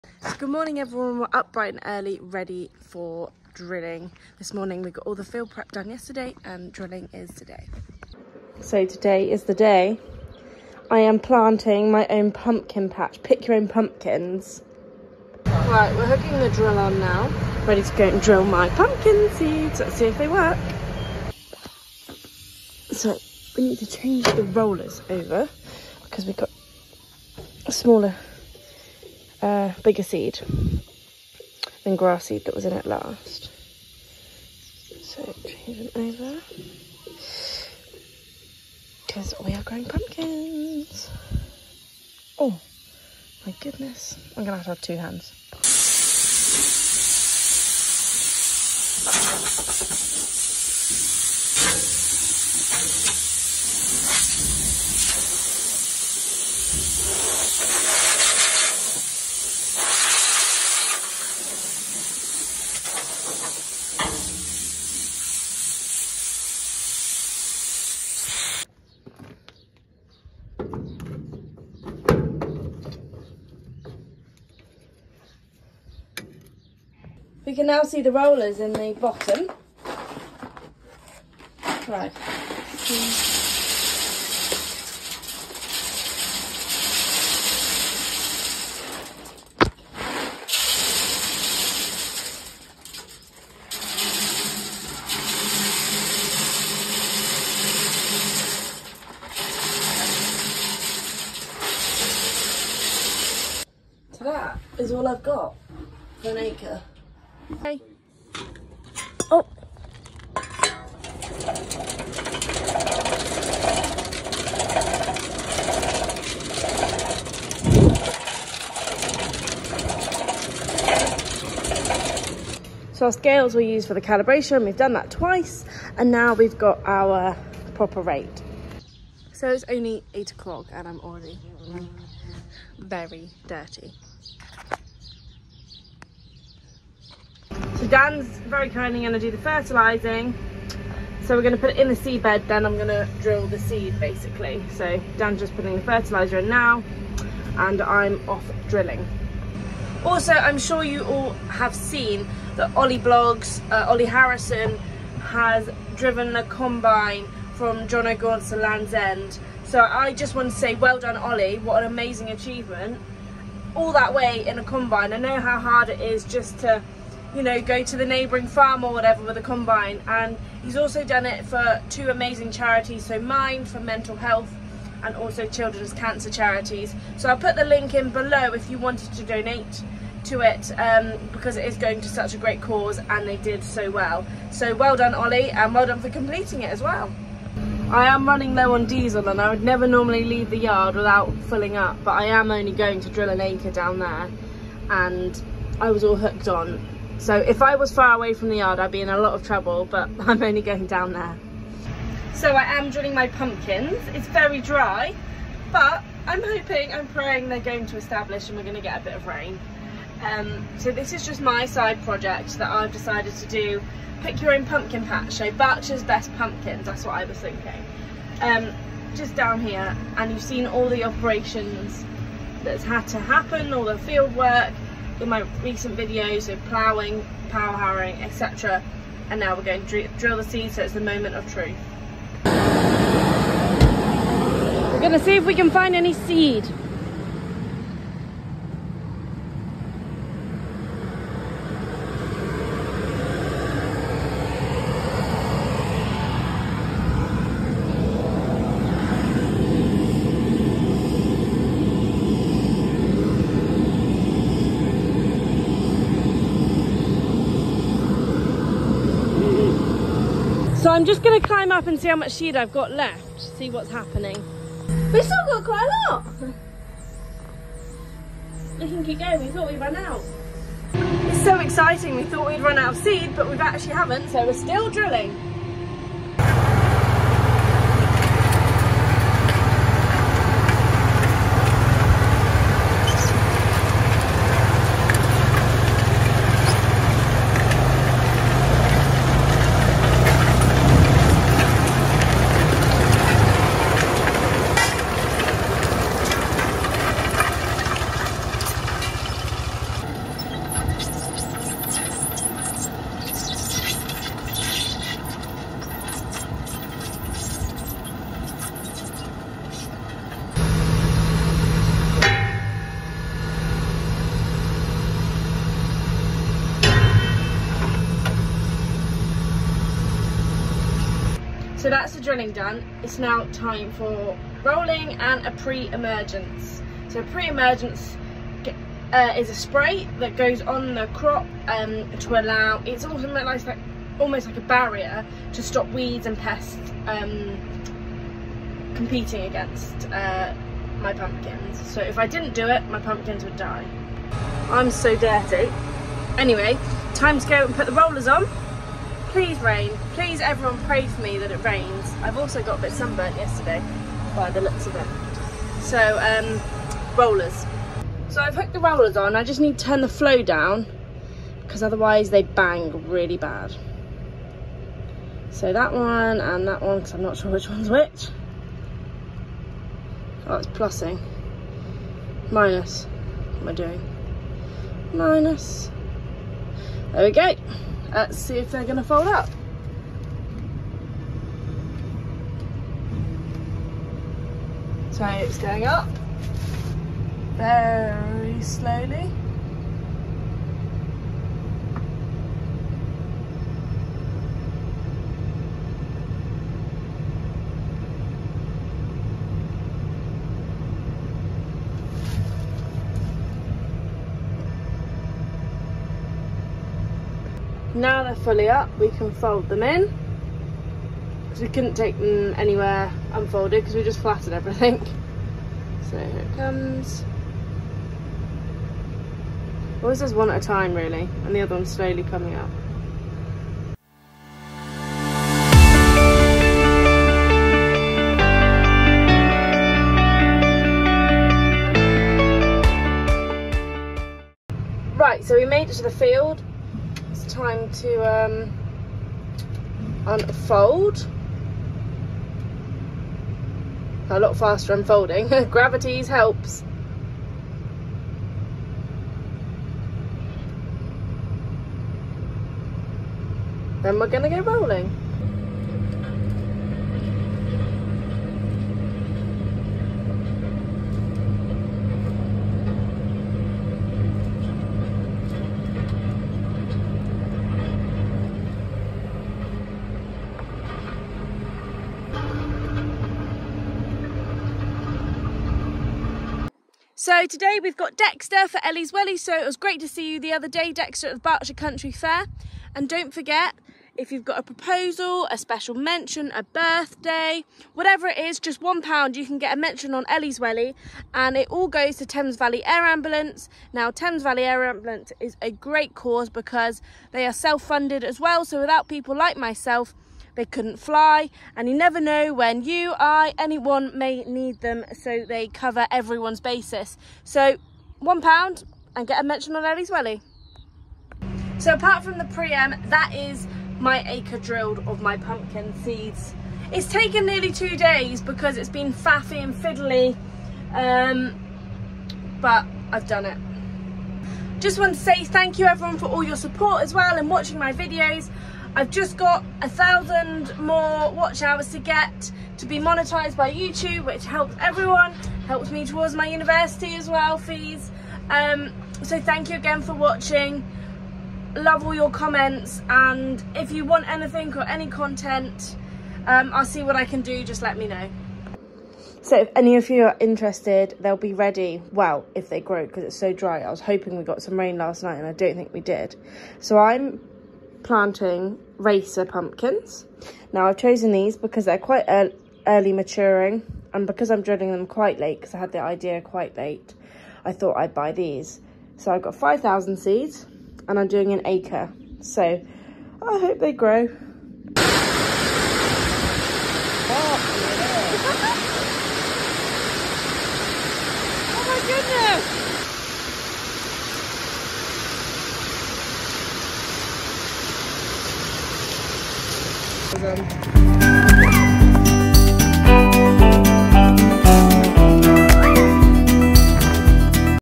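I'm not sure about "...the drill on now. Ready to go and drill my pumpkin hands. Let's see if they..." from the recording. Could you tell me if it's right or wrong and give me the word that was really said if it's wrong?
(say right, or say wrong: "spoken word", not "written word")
wrong: "seeds", not "hands".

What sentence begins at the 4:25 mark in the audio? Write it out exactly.
We've still got quite a lot.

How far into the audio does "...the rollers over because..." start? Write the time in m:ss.
0:24.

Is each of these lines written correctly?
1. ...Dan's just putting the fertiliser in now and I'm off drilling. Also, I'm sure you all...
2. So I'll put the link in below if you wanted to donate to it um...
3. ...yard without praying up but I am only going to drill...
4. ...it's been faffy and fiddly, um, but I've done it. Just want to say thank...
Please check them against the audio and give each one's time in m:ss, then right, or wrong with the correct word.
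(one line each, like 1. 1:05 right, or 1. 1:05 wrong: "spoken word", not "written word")
1. 2:25 right
2. 2:57 right
3. 3:10 wrong: "filling", not "praying"
4. 8:38 right.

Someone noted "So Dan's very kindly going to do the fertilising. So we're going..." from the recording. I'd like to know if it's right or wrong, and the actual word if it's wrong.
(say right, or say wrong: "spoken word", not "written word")
right.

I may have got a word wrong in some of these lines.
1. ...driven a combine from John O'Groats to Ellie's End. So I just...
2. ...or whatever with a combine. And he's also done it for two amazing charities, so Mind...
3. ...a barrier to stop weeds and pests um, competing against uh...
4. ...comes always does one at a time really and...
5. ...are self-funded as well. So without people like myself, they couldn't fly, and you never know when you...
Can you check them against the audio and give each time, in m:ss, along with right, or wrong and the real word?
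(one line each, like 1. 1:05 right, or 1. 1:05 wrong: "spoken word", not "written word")
1. 2:35 wrong: "Land", not "Ellie"
2. 2:48 right
3. 5:34 right
4. 6:56 right
5. 8:17 right.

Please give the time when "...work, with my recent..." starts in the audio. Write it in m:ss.
3:44.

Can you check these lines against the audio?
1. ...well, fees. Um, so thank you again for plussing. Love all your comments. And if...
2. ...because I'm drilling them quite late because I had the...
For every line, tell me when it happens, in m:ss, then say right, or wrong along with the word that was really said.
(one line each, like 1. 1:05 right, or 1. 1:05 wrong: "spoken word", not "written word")
1. 8:57 wrong: "watching", not "plussing"
2. 9:24 right.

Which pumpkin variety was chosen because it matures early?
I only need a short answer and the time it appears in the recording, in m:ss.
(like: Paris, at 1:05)
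Racer, at 9:18.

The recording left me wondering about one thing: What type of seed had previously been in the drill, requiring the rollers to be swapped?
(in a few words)
Grass seed.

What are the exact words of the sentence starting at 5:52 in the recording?
I've also got a bit sunburnt yesterday by the looks of it.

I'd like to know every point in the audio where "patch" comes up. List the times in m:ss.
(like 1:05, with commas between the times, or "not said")
0:12, 3:35.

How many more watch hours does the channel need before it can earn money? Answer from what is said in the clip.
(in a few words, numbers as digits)
1,000.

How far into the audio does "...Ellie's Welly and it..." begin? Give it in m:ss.
8:10.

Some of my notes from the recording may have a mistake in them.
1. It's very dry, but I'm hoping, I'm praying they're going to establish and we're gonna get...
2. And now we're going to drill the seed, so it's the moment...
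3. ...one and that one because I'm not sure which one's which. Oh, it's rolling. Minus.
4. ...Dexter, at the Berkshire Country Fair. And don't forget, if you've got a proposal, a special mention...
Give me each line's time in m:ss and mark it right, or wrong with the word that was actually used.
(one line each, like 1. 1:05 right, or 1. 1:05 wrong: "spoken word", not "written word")
1. 3:24 right
2. 3:49 right
3. 6:05 wrong: "plussing", not "rolling"
4. 8:00 right.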